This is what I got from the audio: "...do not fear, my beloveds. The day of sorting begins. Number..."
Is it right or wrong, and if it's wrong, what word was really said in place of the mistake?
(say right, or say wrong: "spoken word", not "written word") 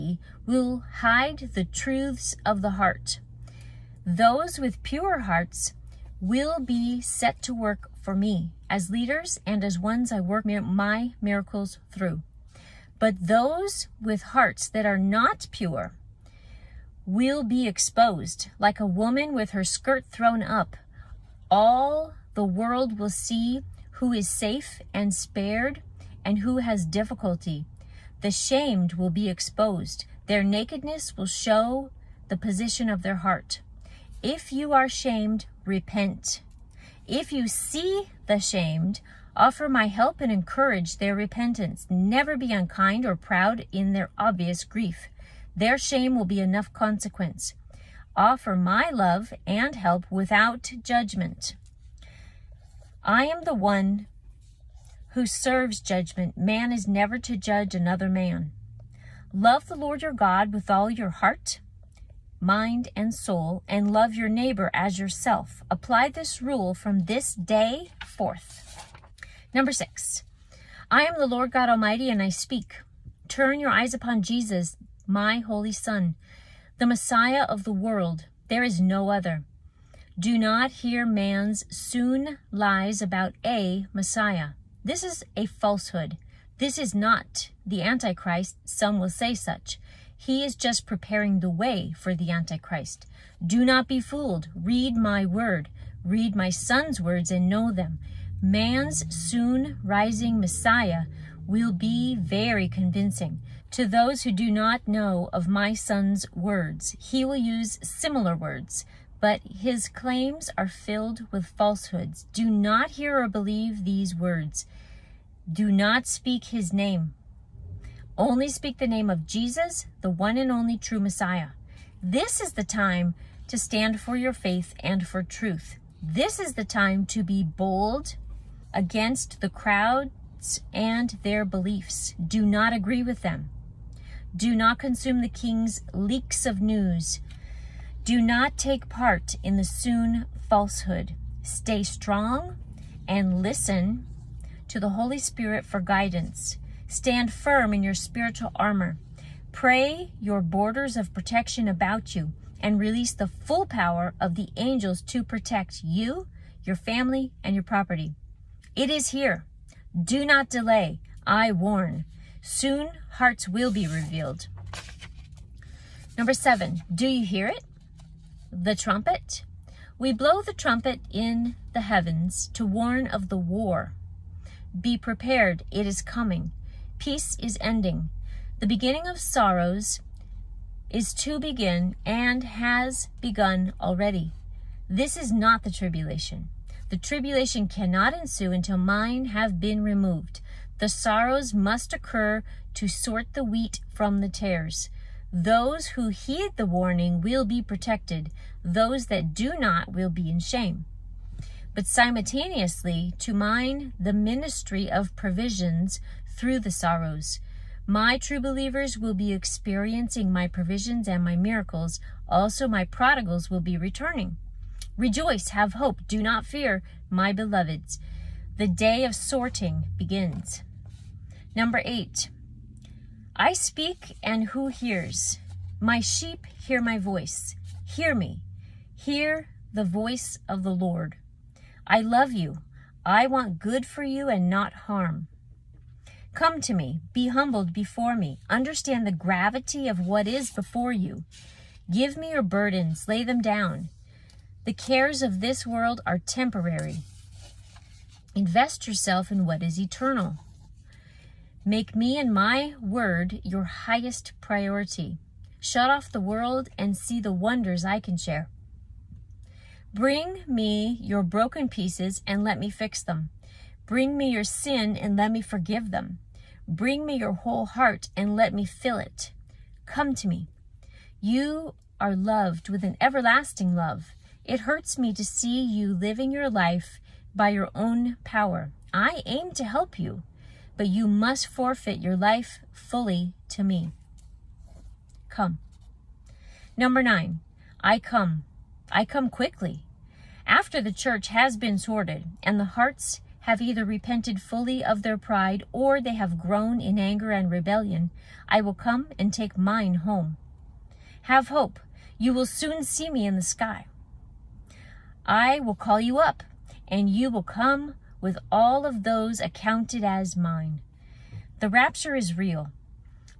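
right.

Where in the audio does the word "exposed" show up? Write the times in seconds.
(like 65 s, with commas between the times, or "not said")
17 s, 29 s.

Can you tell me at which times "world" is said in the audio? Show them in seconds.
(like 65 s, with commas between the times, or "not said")
22 s, 77 s, 245 s, 256 s.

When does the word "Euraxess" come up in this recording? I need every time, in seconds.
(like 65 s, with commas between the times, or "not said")
not said.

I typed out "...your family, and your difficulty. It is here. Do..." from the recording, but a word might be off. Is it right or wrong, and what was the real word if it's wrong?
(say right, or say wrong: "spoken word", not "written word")
wrong: "property", not "difficulty".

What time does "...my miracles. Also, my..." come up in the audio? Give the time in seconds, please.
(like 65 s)
211 s.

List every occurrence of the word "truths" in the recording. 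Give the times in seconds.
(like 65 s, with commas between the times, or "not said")
1 s, 125 s.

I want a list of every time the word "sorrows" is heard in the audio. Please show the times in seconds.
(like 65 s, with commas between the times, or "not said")
179 s, 190 s, 206 s.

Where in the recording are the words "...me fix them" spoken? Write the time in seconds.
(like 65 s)
262 s.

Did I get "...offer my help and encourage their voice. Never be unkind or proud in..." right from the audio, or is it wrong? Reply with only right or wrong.
wrong.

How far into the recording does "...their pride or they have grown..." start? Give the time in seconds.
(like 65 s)
295 s.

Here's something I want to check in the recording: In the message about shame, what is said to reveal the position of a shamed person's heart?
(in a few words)
Their nakedness.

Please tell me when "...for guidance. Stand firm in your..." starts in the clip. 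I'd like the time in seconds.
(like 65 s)
145 s.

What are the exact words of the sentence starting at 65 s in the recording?
Apply this rule from this day forth.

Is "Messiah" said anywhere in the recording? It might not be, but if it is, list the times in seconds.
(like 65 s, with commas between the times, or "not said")
76 s, 83 s, 100 s, 121 s.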